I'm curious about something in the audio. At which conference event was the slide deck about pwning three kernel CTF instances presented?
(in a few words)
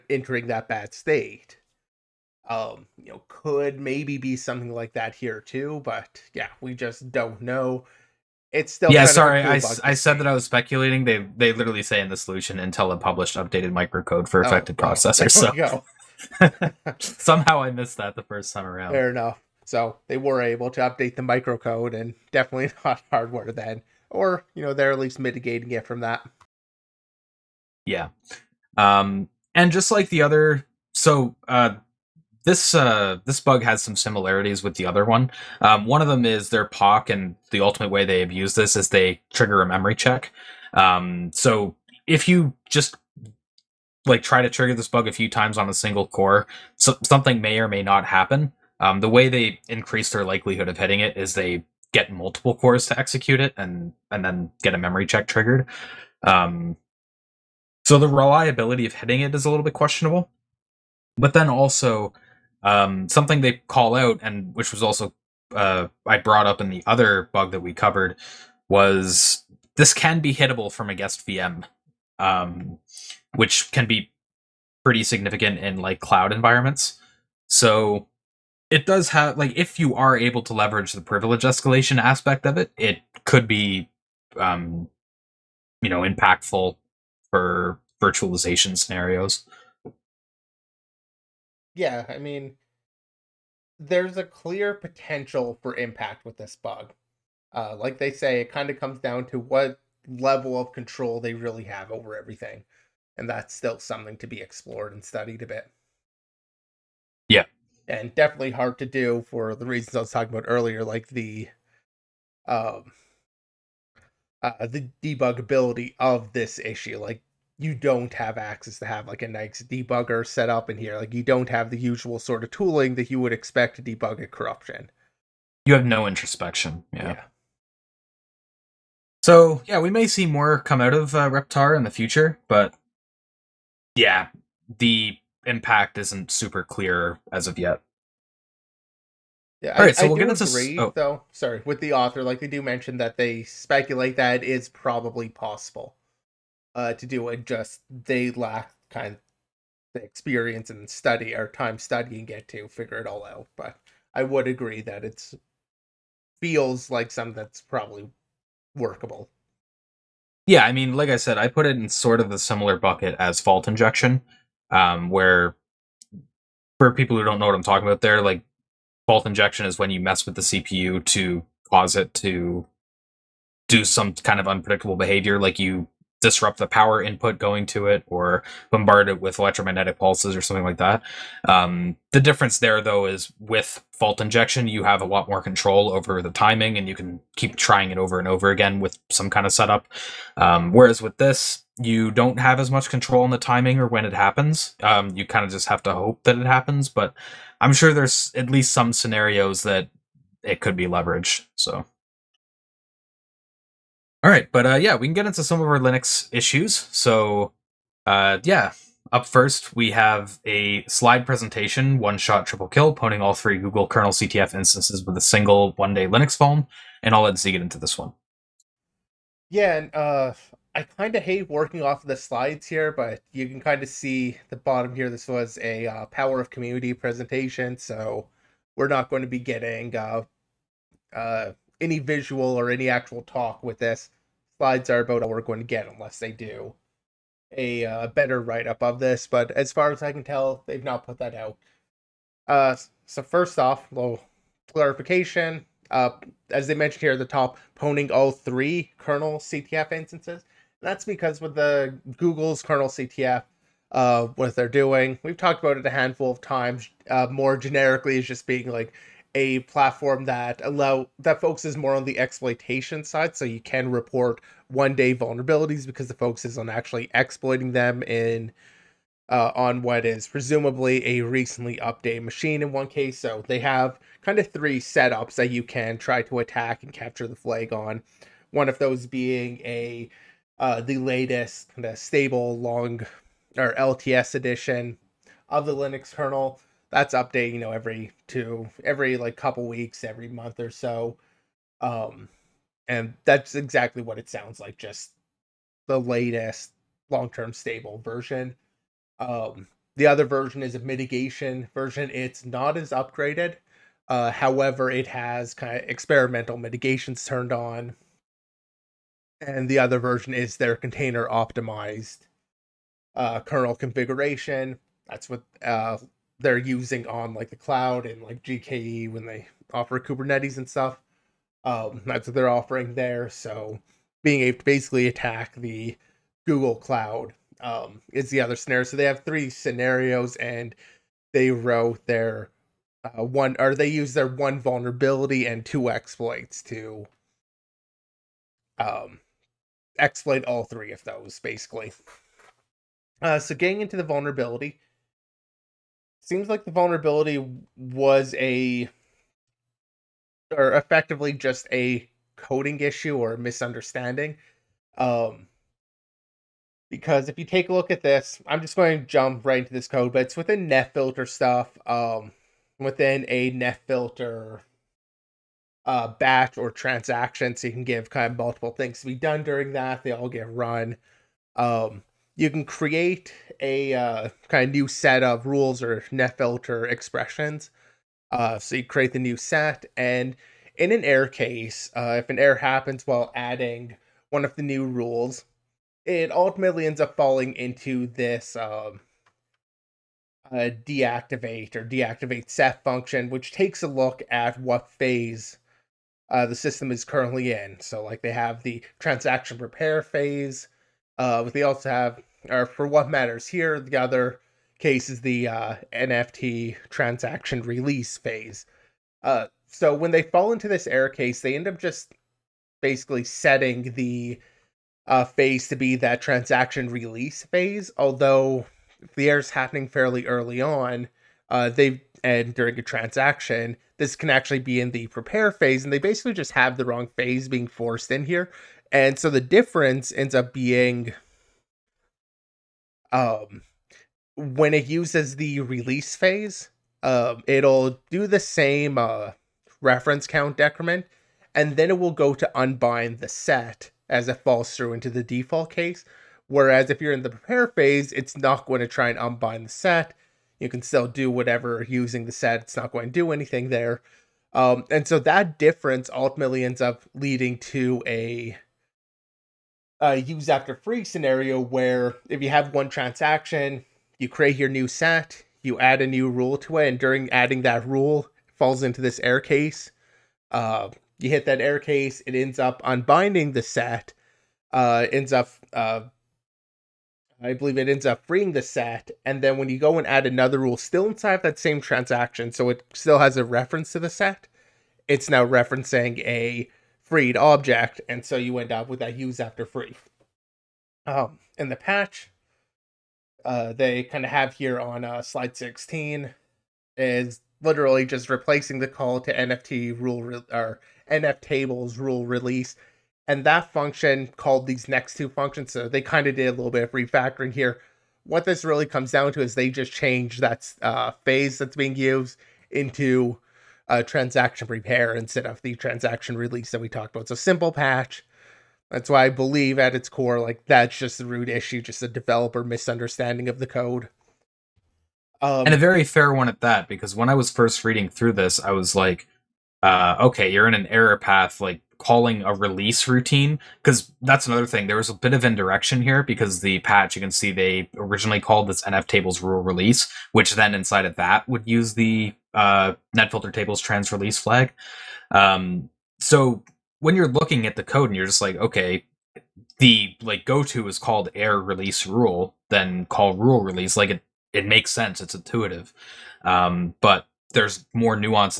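Power of Community.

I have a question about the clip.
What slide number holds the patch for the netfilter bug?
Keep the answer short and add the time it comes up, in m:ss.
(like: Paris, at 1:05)
16, at 8:15.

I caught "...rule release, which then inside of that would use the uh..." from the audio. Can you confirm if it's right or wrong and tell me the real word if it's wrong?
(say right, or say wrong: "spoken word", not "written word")
right.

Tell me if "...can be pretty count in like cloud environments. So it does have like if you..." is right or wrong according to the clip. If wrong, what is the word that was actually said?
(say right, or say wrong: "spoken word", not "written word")
wrong: "significant", not "count".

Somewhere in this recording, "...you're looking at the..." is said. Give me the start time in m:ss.
9:07.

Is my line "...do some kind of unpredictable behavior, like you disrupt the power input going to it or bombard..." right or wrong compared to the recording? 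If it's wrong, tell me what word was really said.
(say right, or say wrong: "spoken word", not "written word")
right.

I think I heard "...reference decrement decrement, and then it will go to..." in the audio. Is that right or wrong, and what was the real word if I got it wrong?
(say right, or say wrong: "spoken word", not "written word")
wrong: "count", not "decrement".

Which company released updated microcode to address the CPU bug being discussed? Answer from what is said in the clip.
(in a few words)
Intel.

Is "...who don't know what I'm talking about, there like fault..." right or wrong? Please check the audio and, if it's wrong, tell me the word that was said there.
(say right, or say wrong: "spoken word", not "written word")
right.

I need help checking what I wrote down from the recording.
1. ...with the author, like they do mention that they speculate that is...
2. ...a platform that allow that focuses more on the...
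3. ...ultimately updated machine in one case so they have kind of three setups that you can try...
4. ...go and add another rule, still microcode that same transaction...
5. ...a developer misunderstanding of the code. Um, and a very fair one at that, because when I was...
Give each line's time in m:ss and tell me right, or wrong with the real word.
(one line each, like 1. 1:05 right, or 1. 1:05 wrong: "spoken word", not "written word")
1. 2:21 right
2. 4:19 right
3. 4:31 wrong: "recently", not "ultimately"
4. 7:59 wrong: "inside", not "microcode"
5. 8:42 right.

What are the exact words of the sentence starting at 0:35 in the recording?
Um, one of them is their POC, and the ultimate way they abuse this is they trigger a memory check.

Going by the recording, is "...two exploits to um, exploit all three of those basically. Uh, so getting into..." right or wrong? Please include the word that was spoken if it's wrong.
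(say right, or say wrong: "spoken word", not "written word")
right.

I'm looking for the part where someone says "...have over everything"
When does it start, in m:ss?
1:41.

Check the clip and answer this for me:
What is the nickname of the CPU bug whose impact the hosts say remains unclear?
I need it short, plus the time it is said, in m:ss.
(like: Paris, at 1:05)
Reptar, at 2:11.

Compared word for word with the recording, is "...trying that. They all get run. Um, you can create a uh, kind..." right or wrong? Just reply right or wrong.
wrong.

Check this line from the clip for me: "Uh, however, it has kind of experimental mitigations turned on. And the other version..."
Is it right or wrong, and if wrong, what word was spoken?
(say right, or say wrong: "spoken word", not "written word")
right.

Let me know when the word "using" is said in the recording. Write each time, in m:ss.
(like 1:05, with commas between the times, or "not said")
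5:16, 7:31.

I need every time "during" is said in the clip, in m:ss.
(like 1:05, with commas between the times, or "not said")
6:09, 7:02, 7:46.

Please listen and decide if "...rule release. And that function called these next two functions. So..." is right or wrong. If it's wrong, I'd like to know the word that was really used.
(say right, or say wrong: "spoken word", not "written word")
right.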